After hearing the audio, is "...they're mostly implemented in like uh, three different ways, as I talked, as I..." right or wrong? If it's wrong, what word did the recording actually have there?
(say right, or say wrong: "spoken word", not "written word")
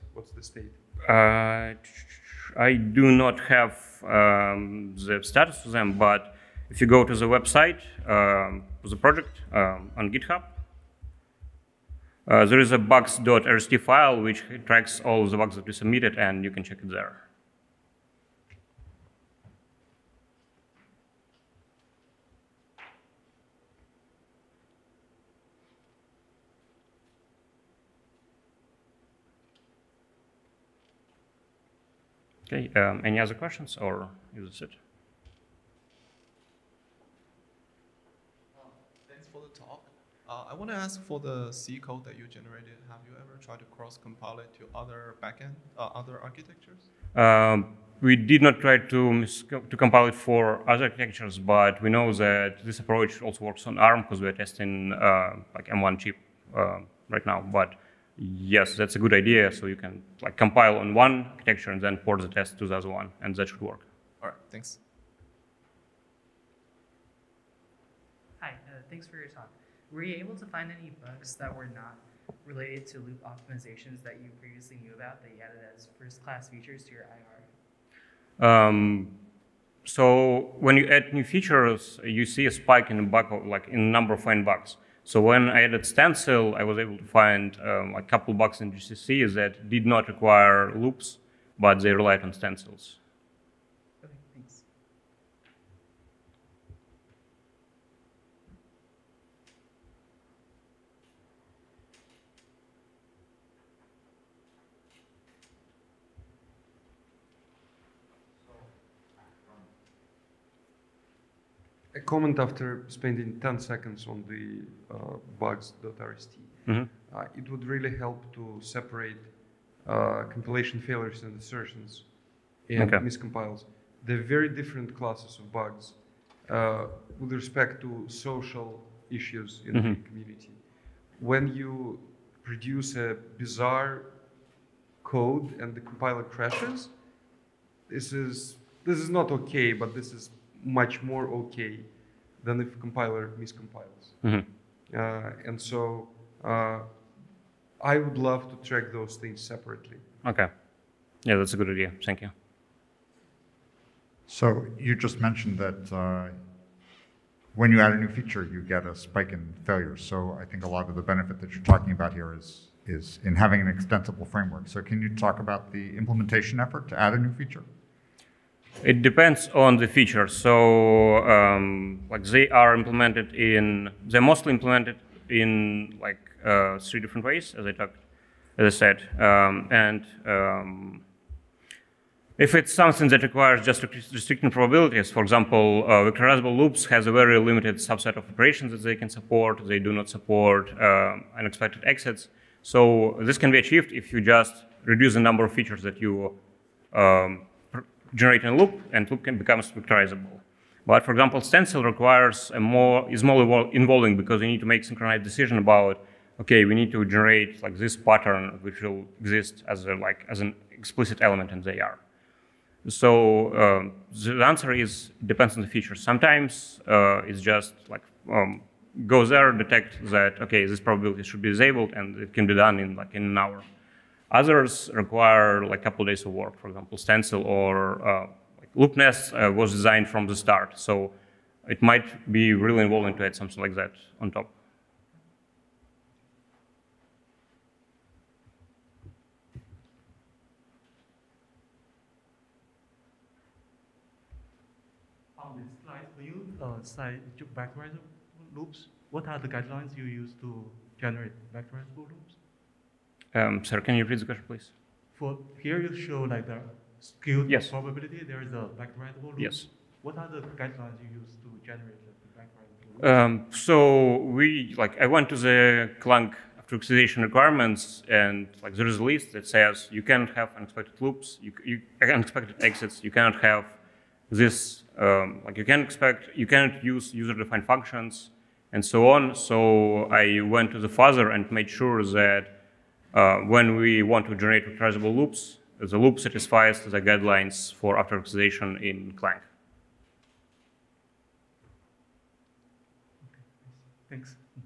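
right.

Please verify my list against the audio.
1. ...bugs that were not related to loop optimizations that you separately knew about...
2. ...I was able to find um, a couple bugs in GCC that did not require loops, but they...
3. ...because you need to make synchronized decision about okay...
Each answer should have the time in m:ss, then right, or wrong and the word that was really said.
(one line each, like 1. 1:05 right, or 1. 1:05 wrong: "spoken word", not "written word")
1. 1:11 wrong: "previously", not "separately"
2. 1:26 right
3. 3:24 right.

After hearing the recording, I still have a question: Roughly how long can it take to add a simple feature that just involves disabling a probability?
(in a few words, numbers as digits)
an hour.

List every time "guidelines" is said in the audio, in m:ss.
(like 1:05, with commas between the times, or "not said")
4:09, 4:20, 4:47.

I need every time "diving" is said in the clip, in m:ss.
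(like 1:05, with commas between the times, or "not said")
not said.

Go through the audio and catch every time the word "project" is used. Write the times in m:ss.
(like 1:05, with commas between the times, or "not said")
0:08.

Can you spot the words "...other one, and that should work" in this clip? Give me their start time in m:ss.
1:02.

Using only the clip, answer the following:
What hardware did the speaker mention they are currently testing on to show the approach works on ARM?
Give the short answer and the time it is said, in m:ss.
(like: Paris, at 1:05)
M1 chip, at 0:55.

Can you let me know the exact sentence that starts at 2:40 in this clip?
So I think a lot of the benefit that you're talking about here is is in having an extensible framework.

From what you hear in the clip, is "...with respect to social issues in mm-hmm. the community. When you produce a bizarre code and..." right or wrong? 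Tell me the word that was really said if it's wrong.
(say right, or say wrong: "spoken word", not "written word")
right.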